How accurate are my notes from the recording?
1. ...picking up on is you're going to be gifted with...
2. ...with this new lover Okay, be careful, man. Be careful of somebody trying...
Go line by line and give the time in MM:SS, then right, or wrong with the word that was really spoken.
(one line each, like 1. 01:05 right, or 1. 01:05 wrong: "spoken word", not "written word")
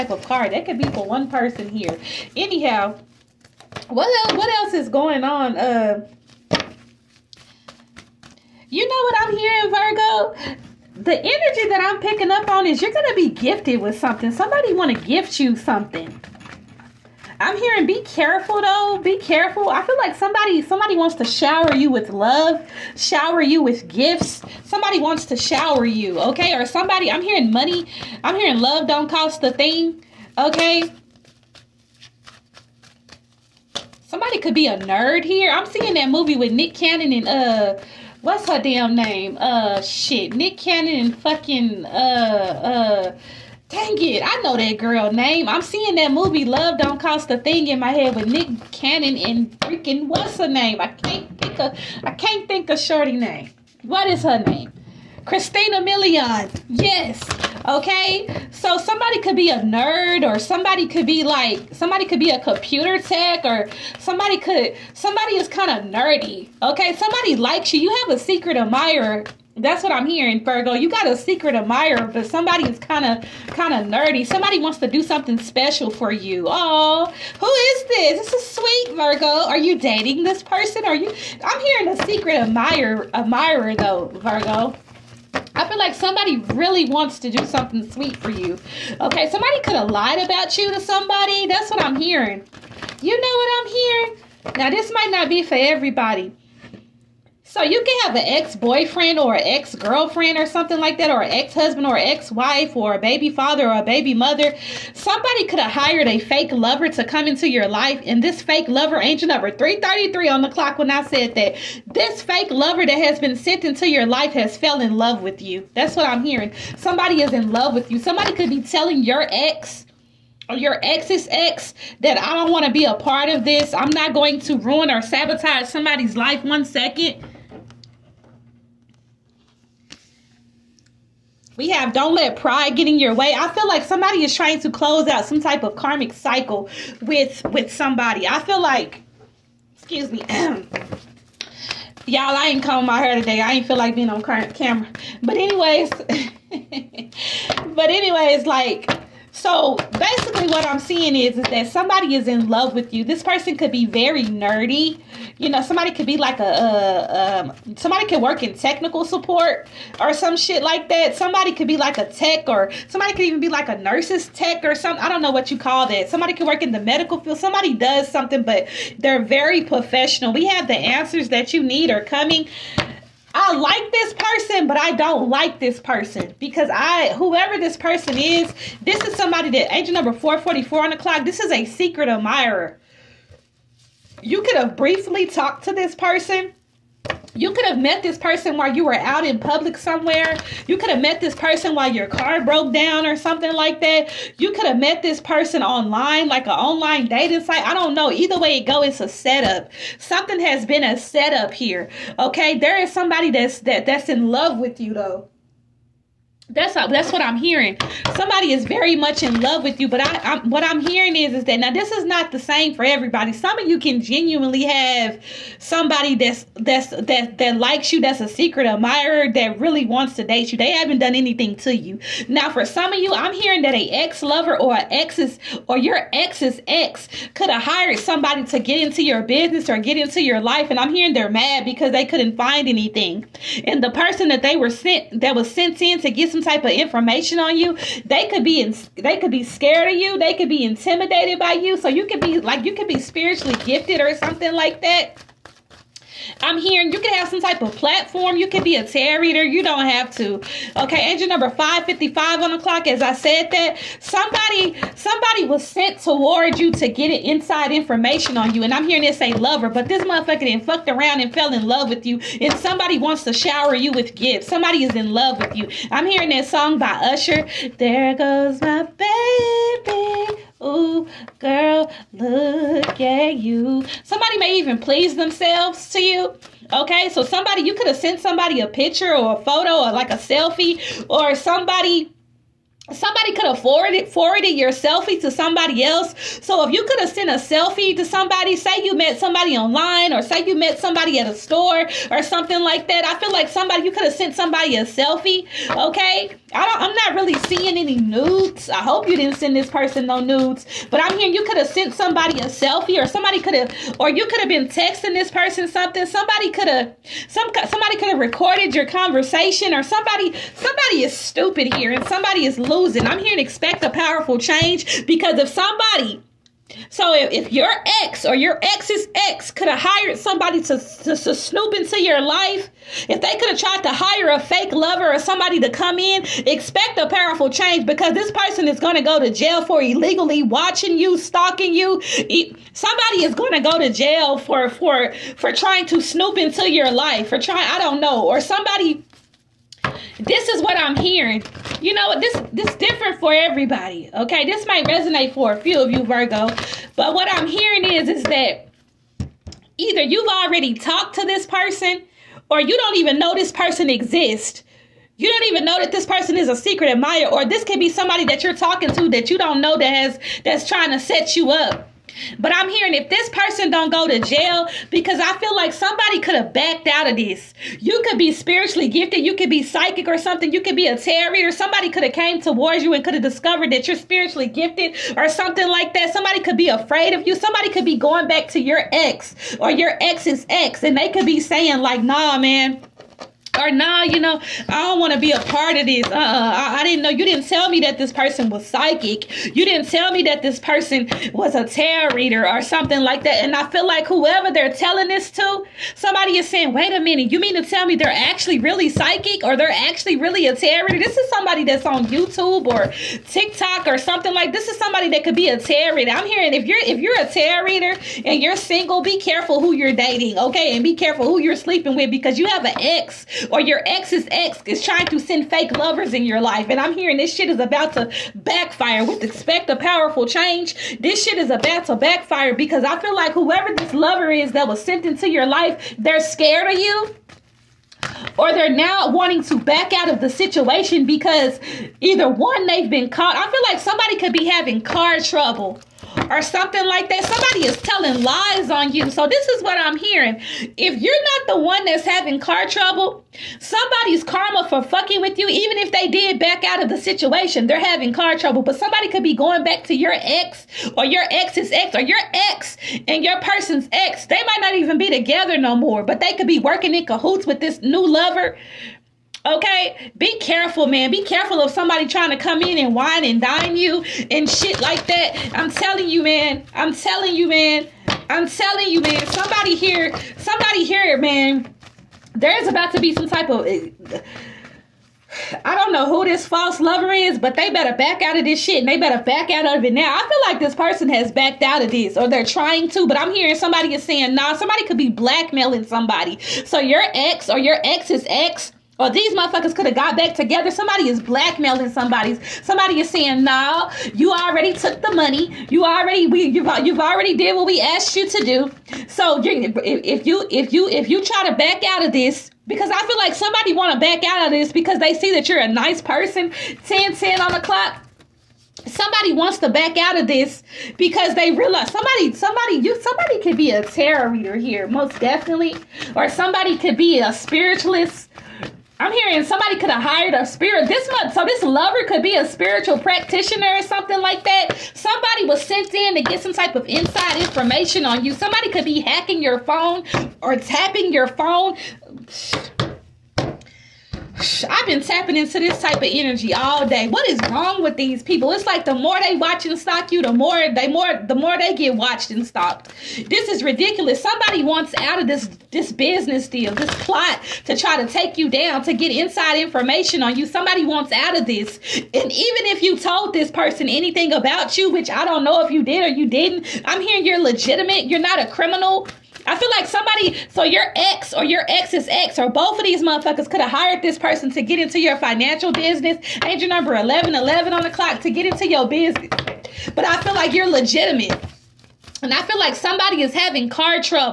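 1. 00:12 right
2. 07:37 right.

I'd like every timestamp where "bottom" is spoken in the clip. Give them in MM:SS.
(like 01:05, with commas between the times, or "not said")
not said.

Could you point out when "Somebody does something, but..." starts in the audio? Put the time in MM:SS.
02:47.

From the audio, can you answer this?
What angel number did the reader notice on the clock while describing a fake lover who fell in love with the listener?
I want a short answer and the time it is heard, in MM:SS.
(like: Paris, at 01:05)
333, at 01:48.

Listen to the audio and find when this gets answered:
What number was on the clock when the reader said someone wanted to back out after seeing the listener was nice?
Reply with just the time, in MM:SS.
08:26.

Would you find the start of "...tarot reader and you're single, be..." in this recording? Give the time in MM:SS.
06:47.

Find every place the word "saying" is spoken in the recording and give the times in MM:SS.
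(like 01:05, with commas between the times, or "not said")
06:21, 06:36, 08:04, 08:13.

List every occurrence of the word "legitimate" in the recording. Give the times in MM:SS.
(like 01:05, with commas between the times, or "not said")
09:17, 09:30.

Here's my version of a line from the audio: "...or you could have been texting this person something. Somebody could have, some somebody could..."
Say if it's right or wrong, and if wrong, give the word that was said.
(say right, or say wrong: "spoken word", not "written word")
right.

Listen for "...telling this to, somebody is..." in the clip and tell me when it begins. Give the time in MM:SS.
06:34.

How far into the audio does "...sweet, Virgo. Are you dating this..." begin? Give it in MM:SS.
01:18.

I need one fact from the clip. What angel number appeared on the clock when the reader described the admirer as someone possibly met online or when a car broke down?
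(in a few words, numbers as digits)
444.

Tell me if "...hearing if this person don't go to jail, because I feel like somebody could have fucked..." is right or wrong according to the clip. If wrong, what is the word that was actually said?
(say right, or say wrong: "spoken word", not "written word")
wrong: "backed", not "fucked".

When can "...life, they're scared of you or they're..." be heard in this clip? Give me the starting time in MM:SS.
07:05.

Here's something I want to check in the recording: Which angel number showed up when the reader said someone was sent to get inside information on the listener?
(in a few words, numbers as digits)
555.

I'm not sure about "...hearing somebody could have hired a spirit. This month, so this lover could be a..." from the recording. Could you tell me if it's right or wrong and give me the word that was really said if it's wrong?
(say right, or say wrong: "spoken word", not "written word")
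right.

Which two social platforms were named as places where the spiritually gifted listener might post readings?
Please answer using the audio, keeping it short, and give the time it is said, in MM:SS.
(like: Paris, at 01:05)
YouTube or TikTok, at 06:42.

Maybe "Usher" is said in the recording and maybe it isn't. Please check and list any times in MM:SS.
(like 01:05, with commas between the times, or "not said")
04:27.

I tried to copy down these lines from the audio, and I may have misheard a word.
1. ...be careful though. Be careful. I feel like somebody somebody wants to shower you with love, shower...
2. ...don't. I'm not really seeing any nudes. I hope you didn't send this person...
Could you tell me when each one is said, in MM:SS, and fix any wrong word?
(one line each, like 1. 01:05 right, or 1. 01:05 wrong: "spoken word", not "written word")
1. 00:17 right
2. 04:56 right.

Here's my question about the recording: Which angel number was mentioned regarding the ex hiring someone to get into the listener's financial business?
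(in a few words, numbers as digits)
1111.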